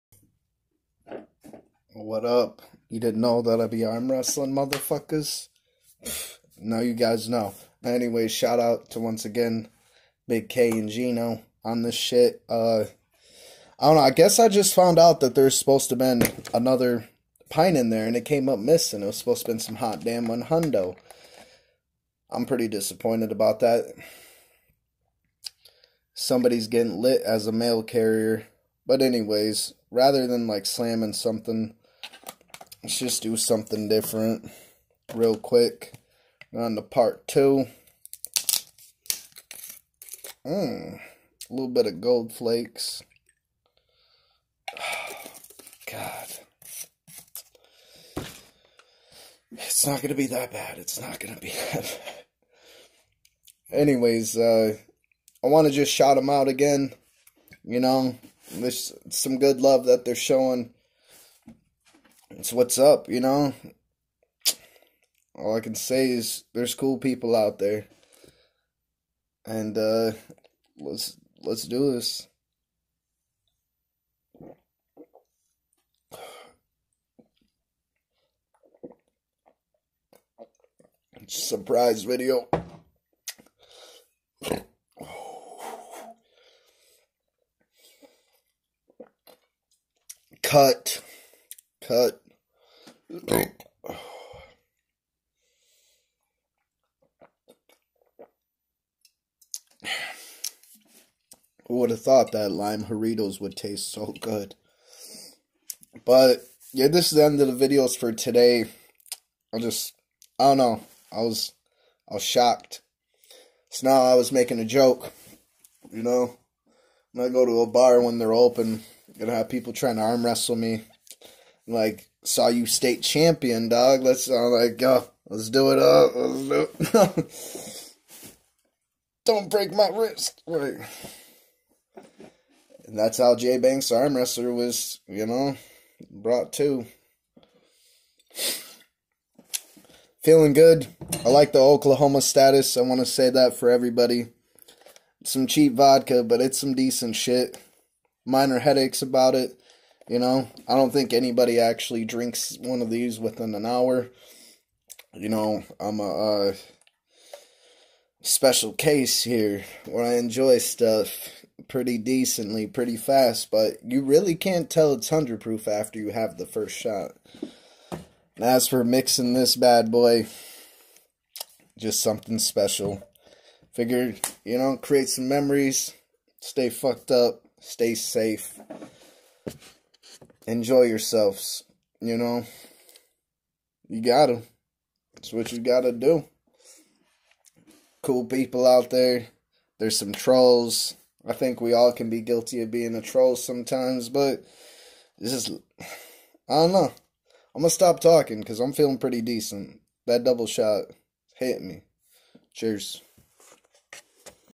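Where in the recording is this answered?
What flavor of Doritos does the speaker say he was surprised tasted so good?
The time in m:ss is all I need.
1:42.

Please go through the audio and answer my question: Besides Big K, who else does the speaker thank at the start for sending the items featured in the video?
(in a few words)
Gino.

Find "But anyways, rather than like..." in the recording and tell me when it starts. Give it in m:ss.
0:28.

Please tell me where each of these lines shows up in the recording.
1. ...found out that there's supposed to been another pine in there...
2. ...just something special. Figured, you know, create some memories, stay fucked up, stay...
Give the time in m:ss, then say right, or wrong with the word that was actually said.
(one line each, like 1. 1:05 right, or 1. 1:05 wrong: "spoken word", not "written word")
1. 0:14 right
2. 2:51 right.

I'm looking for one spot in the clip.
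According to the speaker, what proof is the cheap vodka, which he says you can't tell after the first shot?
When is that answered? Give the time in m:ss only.
2:45.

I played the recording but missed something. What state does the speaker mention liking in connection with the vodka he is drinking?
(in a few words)
Oklahoma.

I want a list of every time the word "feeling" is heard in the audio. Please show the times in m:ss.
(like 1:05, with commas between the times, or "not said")
2:20, 3:18.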